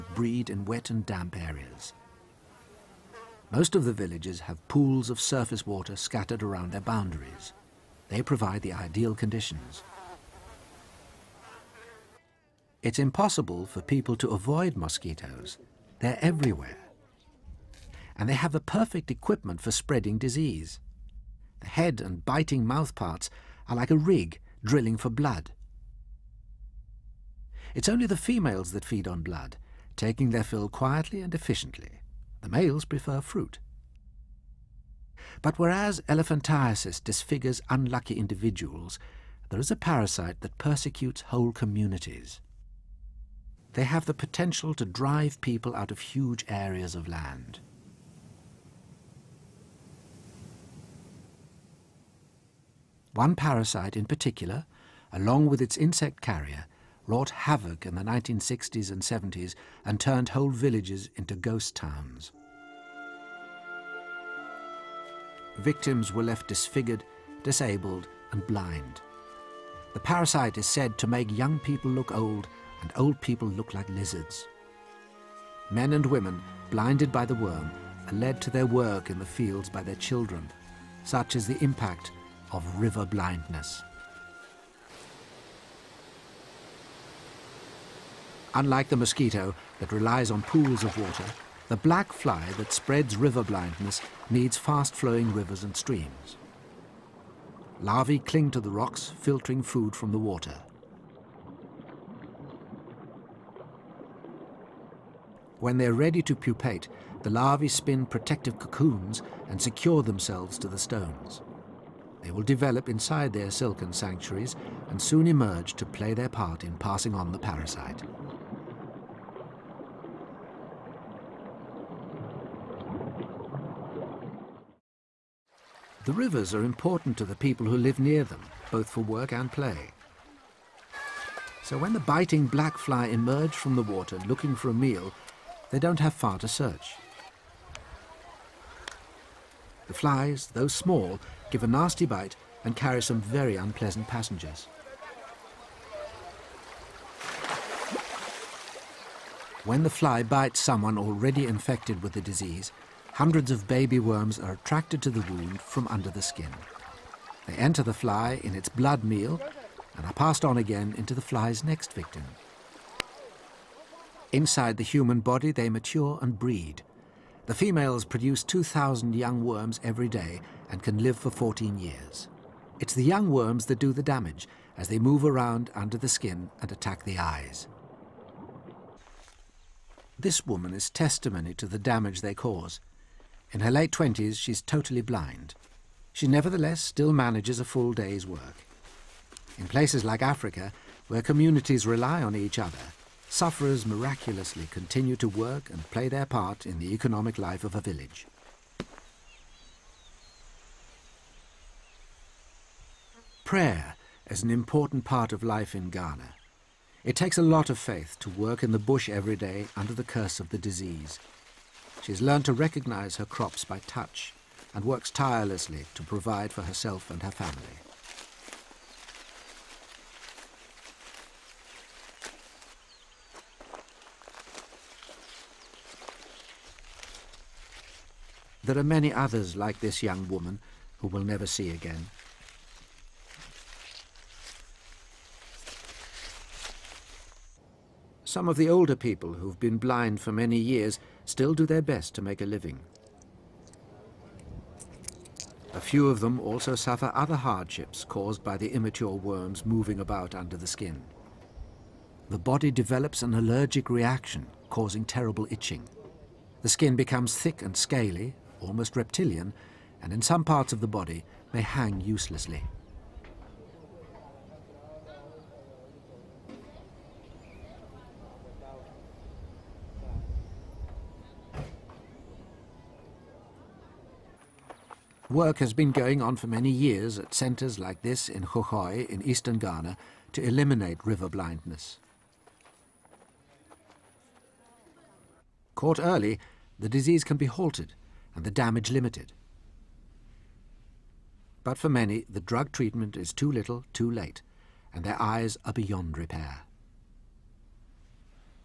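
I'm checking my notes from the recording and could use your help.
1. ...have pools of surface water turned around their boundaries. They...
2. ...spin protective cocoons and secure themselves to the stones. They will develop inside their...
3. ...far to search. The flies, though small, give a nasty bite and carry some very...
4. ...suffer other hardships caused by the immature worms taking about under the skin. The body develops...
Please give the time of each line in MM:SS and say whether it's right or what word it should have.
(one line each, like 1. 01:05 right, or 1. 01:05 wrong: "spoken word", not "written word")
1. 00:04 wrong: "scattered", not "turned"
2. 01:47 right
3. 02:16 right
4. 04:06 wrong: "moving", not "taking".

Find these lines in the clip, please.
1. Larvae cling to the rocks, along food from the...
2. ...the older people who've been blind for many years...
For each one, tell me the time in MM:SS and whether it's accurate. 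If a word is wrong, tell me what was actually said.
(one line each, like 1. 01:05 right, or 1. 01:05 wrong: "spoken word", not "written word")
1. 01:37 wrong: "filtering", not "along"
2. 03:58 right.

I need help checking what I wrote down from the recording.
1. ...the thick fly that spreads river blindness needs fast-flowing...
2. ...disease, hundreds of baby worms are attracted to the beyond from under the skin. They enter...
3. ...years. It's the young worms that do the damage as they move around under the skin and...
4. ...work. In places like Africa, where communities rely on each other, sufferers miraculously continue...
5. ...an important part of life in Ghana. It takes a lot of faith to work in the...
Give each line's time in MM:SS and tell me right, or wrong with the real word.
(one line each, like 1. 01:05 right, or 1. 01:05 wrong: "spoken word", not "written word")
1. 01:31 wrong: "black", not "thick"
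2. 02:32 wrong: "wound", not "beyond"
3. 02:51 right
4. 03:08 right
5. 03:24 right.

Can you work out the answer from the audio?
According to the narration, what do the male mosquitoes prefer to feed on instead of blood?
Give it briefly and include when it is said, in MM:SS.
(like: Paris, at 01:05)
Fruit, at 00:33.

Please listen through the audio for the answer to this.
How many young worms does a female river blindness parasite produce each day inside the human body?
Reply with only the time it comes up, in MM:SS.
02:48.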